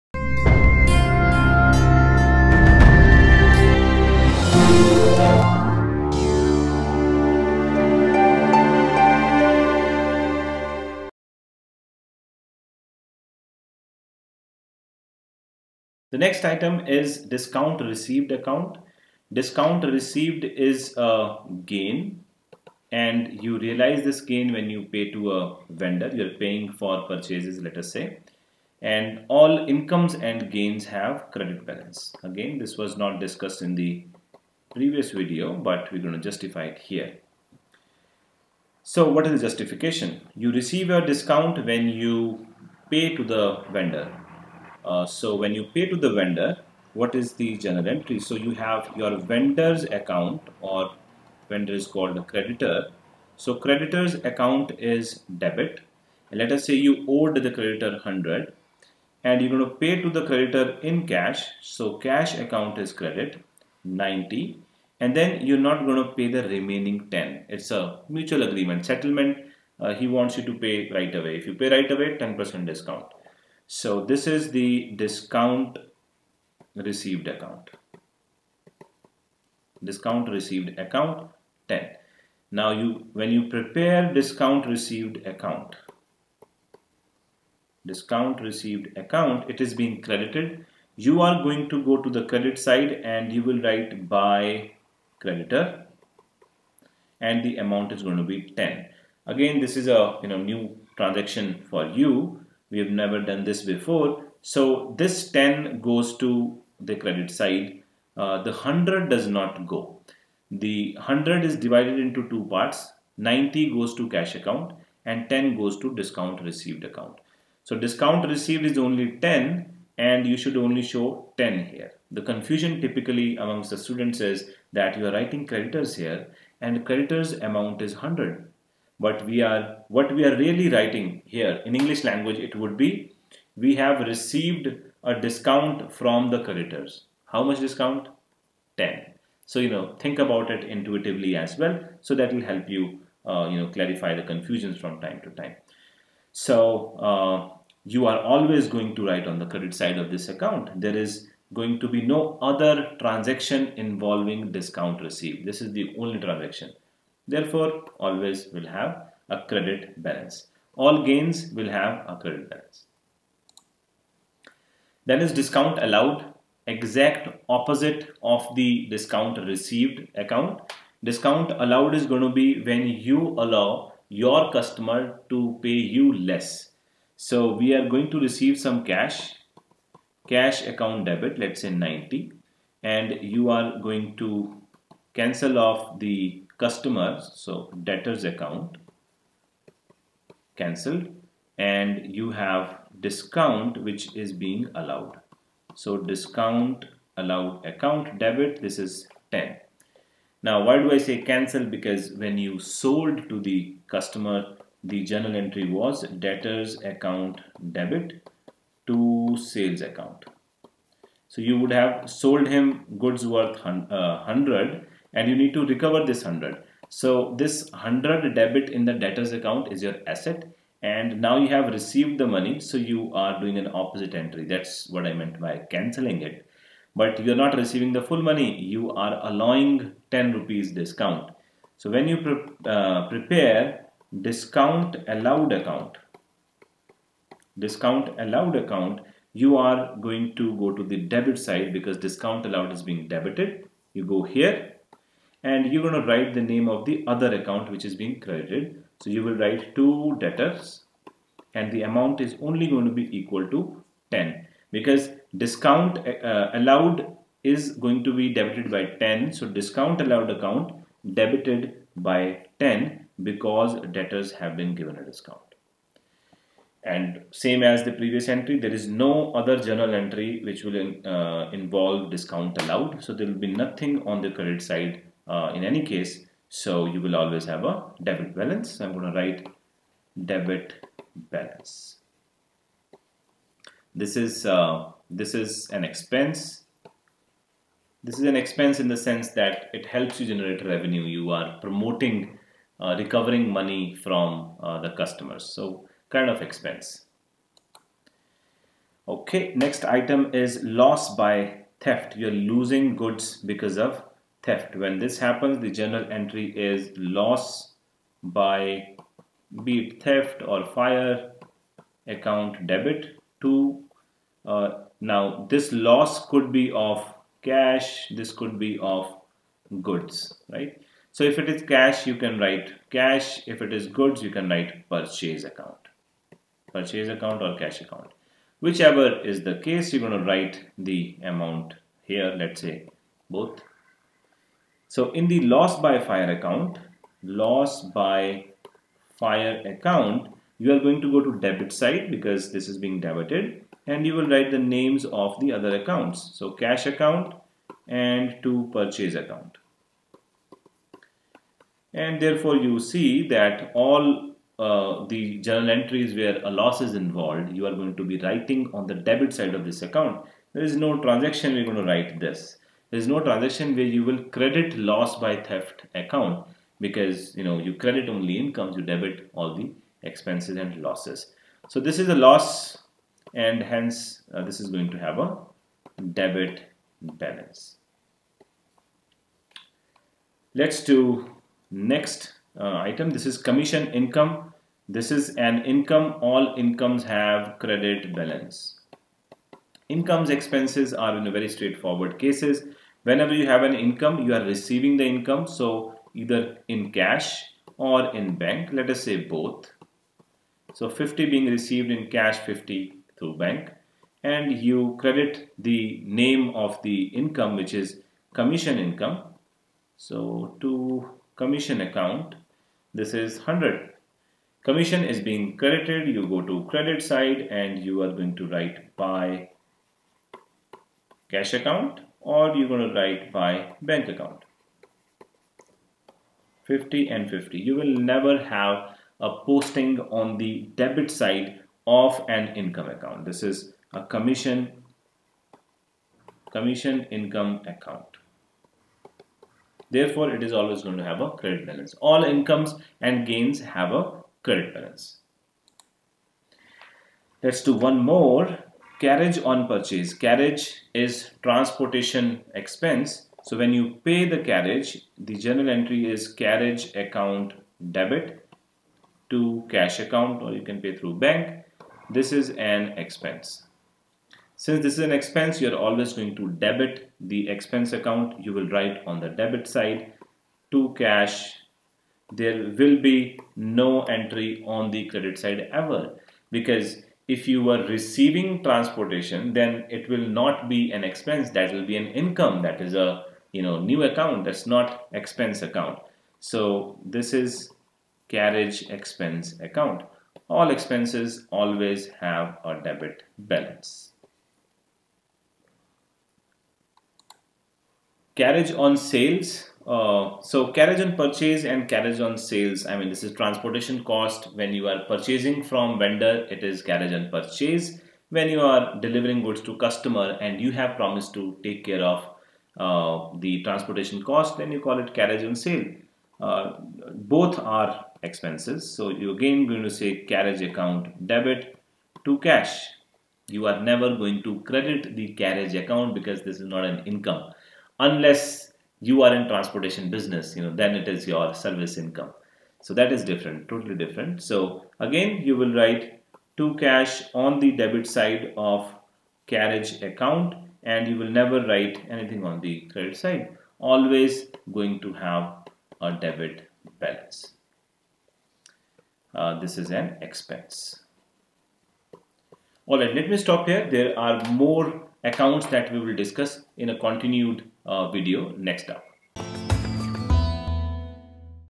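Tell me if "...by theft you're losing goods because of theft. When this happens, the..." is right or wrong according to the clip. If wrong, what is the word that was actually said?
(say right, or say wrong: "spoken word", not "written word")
right.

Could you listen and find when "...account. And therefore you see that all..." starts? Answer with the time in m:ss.
5:49.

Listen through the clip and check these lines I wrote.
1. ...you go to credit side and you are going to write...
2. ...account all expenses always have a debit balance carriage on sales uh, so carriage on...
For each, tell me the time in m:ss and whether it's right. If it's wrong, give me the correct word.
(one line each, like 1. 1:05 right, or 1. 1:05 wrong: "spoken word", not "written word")
1. 6:56 right
2. 8:09 right.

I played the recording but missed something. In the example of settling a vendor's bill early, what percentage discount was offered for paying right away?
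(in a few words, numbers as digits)
10%.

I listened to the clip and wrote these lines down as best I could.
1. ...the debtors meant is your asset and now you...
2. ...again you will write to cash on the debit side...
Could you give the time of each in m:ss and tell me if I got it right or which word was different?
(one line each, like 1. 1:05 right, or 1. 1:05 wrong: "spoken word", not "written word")
1. 3:38 wrong: "account", not "meant"
2. 8:54 right.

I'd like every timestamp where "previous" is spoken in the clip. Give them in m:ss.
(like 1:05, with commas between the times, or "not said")
0:34, 4:27.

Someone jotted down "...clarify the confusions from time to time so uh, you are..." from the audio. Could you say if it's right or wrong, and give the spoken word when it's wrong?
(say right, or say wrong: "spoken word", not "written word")
right.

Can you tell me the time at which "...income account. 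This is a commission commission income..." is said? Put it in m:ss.
7:12.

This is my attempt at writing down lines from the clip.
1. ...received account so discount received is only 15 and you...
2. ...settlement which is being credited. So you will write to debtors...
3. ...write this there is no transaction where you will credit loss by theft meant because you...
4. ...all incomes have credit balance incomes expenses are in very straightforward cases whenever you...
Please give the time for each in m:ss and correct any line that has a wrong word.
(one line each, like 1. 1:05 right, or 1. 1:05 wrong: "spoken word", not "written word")
1. 1:56 wrong: "10", not "15"
2. 4:07 wrong: "account", not "settlement"
3. 6:01 wrong: "account", not "meant"
4. 6:26 right.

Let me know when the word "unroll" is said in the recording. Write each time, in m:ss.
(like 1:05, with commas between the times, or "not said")
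not said.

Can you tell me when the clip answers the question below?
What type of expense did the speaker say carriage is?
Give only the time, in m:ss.
7:31.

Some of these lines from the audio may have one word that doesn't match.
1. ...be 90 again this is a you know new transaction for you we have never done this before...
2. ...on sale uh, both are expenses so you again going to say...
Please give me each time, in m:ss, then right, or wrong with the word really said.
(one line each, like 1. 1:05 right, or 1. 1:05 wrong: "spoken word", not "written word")
1. 1:38 wrong: "10", not "90"
2. 8:35 right.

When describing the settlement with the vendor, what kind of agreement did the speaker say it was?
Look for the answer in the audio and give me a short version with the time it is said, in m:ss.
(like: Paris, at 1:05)
mutual agreement settlement, at 1:08.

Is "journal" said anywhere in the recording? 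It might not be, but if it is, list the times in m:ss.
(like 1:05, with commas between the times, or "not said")
0:47, 3:25, 4:29, 5:05, 5:55, 7:35.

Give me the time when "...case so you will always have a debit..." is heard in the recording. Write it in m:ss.
4:35.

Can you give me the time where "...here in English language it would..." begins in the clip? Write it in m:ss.
2:11.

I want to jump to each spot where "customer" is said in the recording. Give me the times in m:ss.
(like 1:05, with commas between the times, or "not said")
2:54, 3:06, 3:23, 4:54, 8:29.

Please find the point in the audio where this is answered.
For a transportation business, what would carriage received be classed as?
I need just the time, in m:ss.
8:51.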